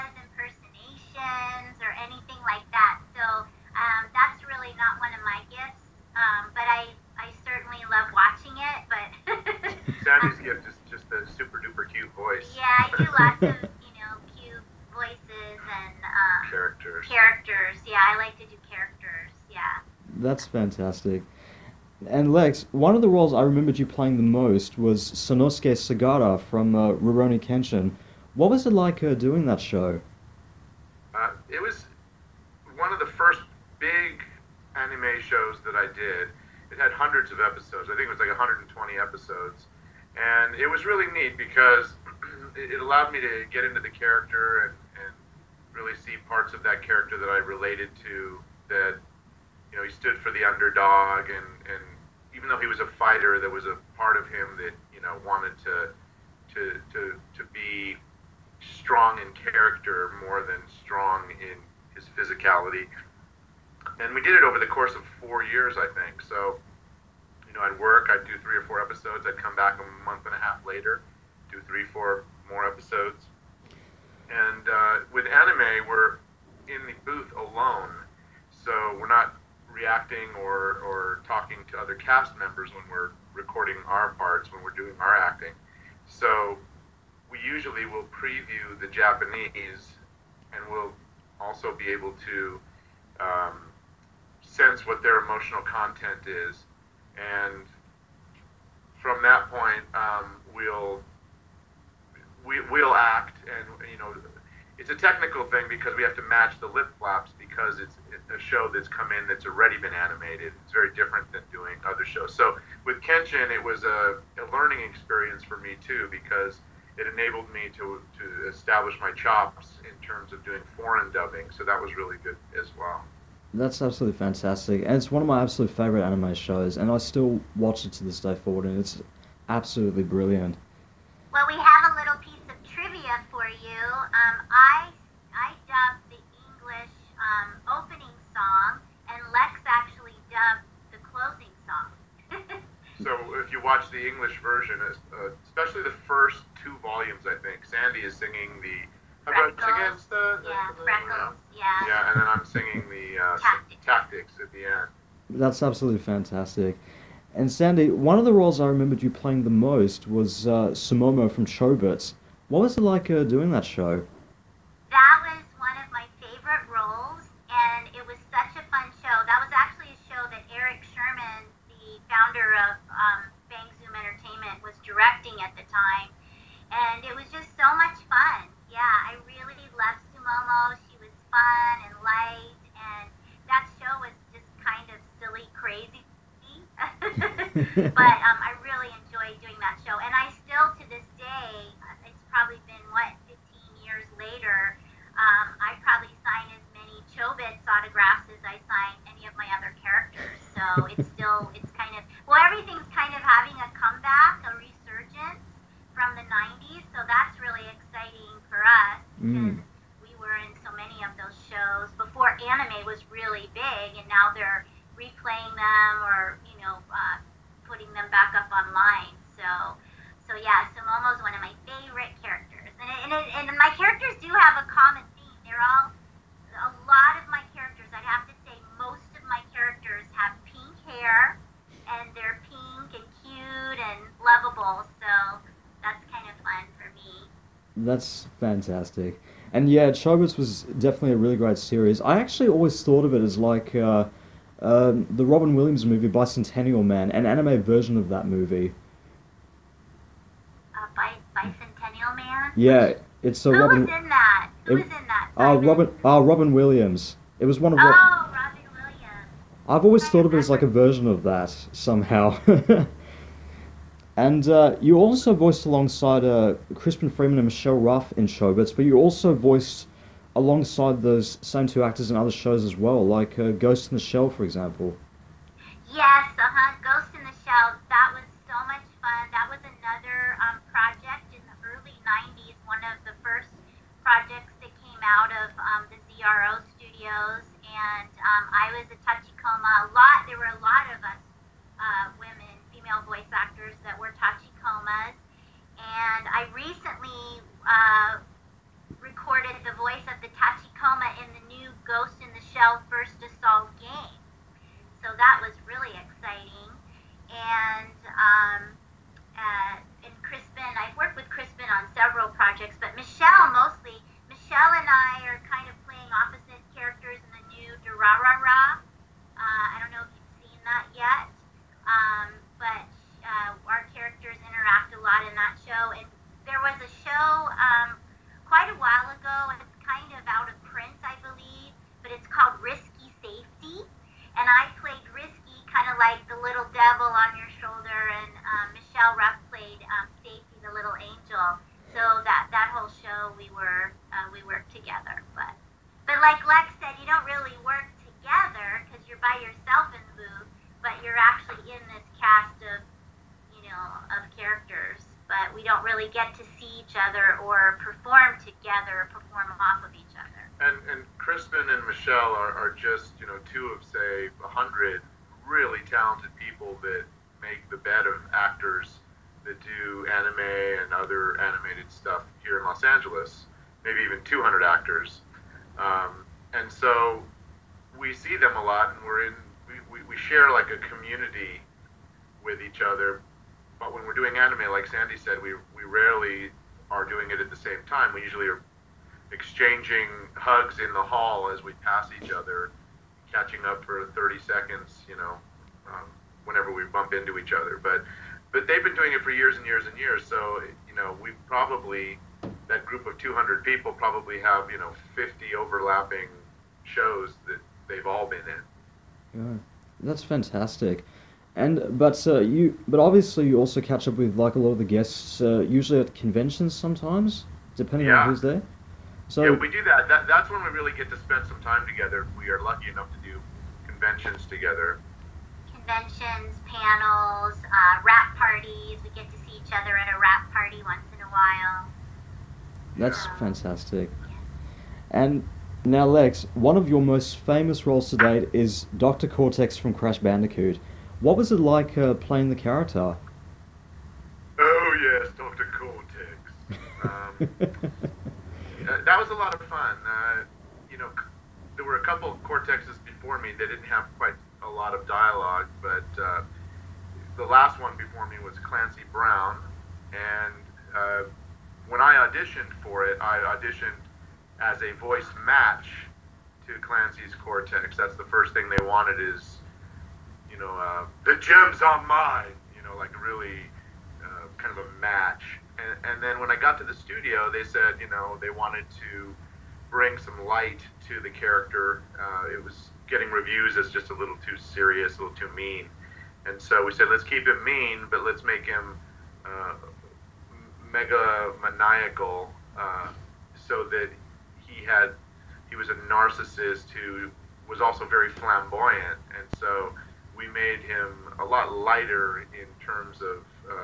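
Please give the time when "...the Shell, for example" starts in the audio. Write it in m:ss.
4:33.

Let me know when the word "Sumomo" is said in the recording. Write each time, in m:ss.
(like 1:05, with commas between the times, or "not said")
2:40, 3:00.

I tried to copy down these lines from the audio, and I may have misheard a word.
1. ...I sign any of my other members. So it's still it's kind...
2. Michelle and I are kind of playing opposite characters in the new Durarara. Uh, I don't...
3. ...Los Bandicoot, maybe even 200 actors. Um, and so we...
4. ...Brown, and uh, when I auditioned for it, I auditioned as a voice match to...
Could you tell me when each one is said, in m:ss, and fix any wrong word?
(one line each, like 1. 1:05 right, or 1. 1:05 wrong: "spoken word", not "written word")
1. 3:18 wrong: "characters", not "members"
2. 5:14 right
3. 6:12 wrong: "Angeles", not "Bandicoot"
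4. 7:39 right.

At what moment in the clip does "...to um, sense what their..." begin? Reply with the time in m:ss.
1:32.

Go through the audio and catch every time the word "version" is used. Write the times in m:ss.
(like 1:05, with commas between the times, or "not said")
2:24, 4:07, 4:20.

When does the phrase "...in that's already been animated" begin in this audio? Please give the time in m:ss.
1:49.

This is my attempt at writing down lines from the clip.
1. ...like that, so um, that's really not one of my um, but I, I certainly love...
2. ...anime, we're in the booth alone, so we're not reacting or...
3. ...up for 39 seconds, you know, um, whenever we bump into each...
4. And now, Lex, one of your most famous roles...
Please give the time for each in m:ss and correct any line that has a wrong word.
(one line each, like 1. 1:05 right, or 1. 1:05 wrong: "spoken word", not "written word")
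1. 0:02 right
2. 1:15 right
3. 6:33 wrong: "30", not "39"
4. 7:15 right.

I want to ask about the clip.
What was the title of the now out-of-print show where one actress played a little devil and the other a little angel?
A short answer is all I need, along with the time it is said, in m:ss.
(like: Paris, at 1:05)
Risky Safety, at 5:32.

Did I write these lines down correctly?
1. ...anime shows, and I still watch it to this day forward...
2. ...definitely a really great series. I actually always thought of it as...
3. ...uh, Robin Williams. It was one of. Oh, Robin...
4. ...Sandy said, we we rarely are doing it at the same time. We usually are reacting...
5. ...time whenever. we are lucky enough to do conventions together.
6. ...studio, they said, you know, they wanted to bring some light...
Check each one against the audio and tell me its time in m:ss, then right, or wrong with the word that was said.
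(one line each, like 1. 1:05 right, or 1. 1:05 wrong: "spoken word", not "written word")
1. 2:06 right
2. 4:00 right
3. 4:16 right
4. 6:24 wrong: "exchanging", not "reacting"
5. 7:01 wrong: "together", not "whenever"
6. 7:56 right.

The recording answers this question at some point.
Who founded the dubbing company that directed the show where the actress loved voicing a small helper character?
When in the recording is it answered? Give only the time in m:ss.
2:50.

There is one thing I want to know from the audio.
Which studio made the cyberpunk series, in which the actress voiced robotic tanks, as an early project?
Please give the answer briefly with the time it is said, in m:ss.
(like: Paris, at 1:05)
ZRO, at 4:46.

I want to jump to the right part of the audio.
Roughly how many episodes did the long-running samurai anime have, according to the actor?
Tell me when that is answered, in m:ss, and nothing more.
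0:38.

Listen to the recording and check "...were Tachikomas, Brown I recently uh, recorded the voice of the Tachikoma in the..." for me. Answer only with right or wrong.
wrong.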